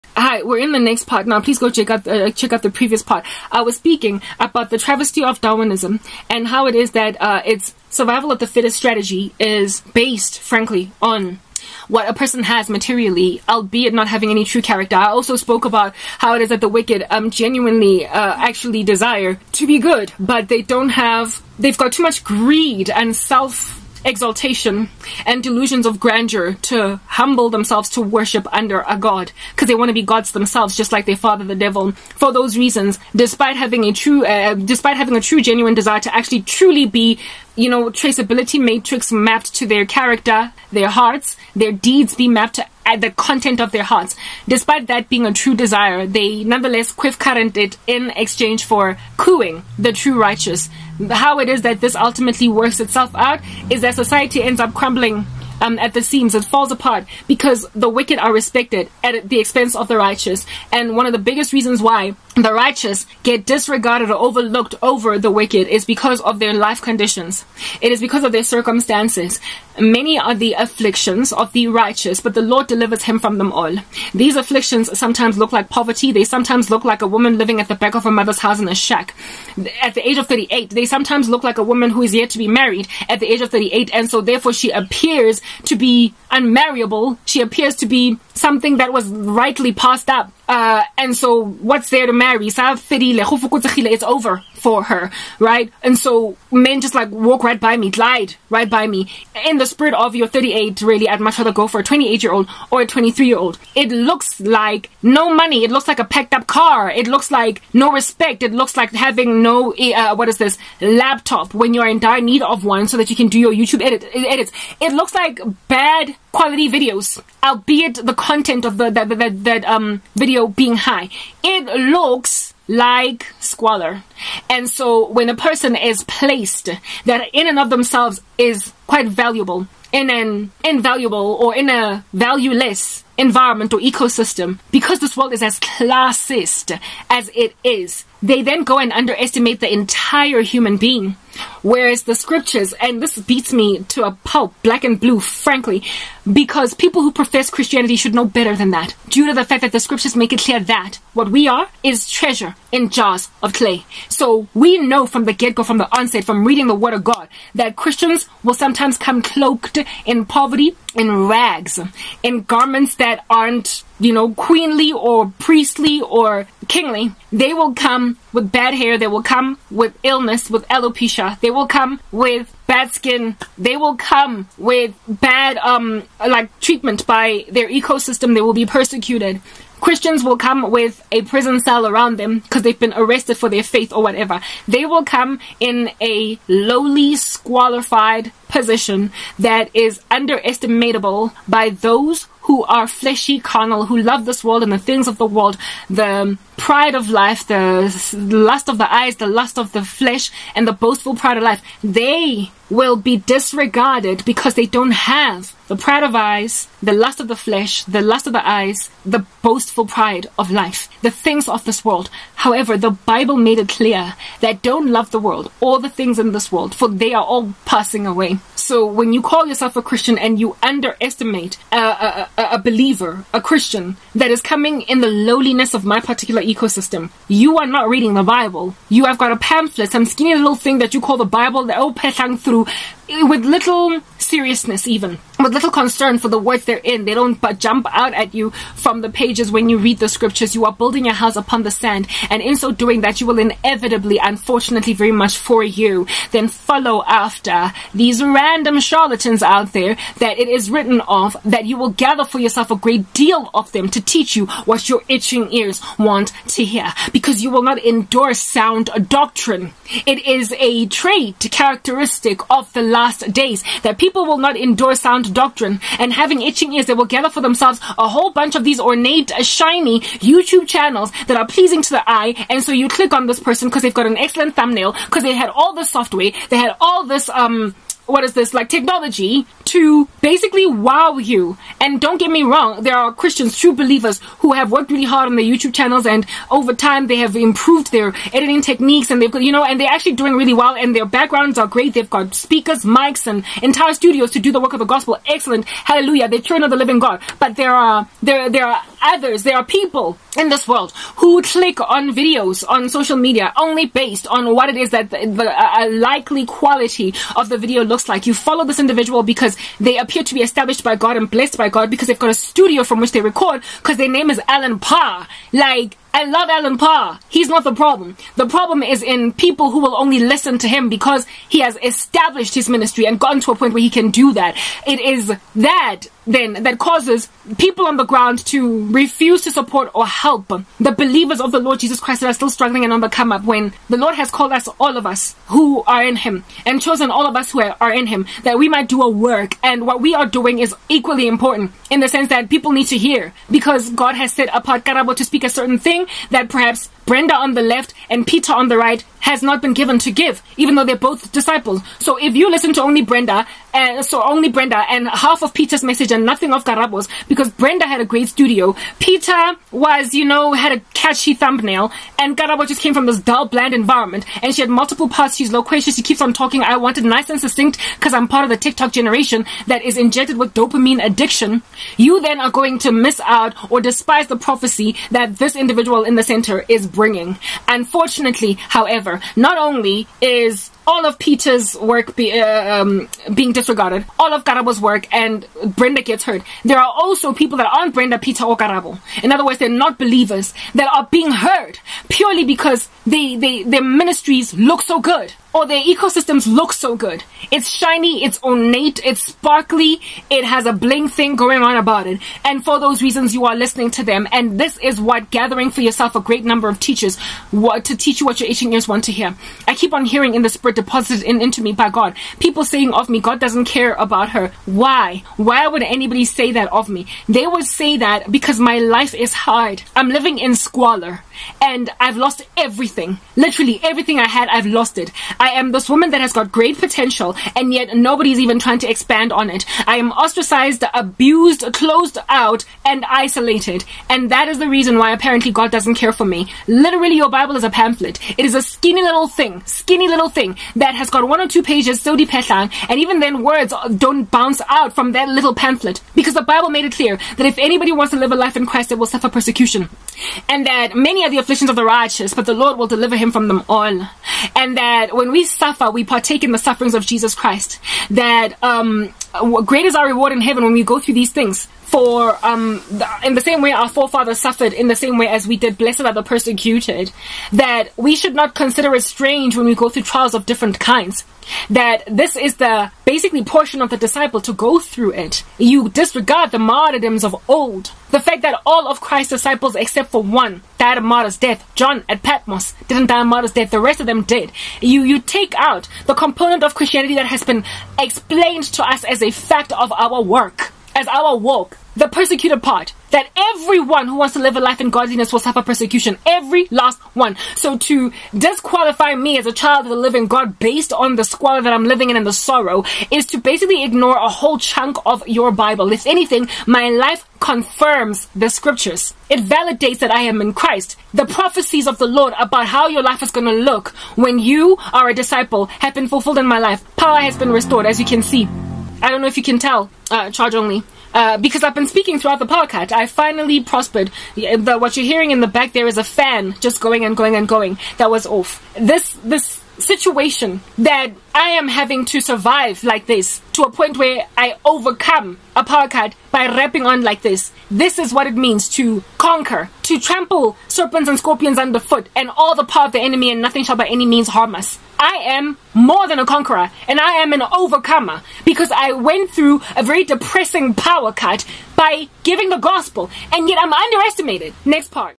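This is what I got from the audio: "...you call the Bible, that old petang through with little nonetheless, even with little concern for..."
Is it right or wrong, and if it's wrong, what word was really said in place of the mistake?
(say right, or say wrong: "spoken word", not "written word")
wrong: "seriousness", not "nonetheless".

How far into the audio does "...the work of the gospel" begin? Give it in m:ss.
4:54.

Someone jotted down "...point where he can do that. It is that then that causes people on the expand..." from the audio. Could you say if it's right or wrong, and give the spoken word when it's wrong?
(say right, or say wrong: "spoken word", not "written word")
wrong: "ground", not "expand".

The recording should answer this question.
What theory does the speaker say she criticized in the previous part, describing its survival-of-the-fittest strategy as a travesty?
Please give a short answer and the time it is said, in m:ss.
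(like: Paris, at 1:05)
Darwinism, at 0:05.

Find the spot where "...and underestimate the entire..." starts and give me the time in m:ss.
2:18.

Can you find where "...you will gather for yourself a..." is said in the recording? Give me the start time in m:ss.
4:11.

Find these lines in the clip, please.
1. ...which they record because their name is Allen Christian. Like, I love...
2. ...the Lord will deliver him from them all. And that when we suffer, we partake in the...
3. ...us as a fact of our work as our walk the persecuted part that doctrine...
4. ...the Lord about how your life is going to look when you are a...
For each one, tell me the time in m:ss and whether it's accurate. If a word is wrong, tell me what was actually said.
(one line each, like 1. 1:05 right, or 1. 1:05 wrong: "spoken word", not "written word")
1. 5:13 wrong: "Parr", not "Christian"
2. 7:32 right
3. 8:08 wrong: "everyone", not "doctrine"
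4. 8:31 right.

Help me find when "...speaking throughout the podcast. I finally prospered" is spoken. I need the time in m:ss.
8:41.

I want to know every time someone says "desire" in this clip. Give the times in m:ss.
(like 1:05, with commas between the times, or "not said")
0:18, 0:35, 0:45.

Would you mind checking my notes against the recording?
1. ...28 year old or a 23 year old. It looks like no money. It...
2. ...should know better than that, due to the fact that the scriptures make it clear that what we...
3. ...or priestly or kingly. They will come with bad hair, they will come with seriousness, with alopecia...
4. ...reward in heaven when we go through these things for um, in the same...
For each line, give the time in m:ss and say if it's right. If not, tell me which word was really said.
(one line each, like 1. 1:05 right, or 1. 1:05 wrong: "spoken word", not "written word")
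1. 1:41 right
2. 2:27 right
3. 2:44 wrong: "illness", not "seriousness"
4. 7:40 right.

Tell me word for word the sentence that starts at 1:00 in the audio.
And one of the biggest reasons why the righteous get disregarded or overlooked over the wicked is because of their life conditions.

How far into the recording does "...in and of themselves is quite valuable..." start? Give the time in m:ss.
2:07.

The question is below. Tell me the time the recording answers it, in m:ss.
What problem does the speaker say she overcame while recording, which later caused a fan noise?
9:10.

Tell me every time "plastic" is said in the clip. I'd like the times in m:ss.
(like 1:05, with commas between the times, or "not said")
not said.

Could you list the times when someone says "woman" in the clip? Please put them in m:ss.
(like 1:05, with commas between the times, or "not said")
1:17, 1:21, 7:05.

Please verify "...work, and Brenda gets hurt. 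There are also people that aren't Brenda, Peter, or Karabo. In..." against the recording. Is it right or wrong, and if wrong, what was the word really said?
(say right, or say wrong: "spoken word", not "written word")
right.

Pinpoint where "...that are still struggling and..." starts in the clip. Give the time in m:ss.
5:32.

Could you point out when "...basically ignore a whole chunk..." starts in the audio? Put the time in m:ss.
8:23.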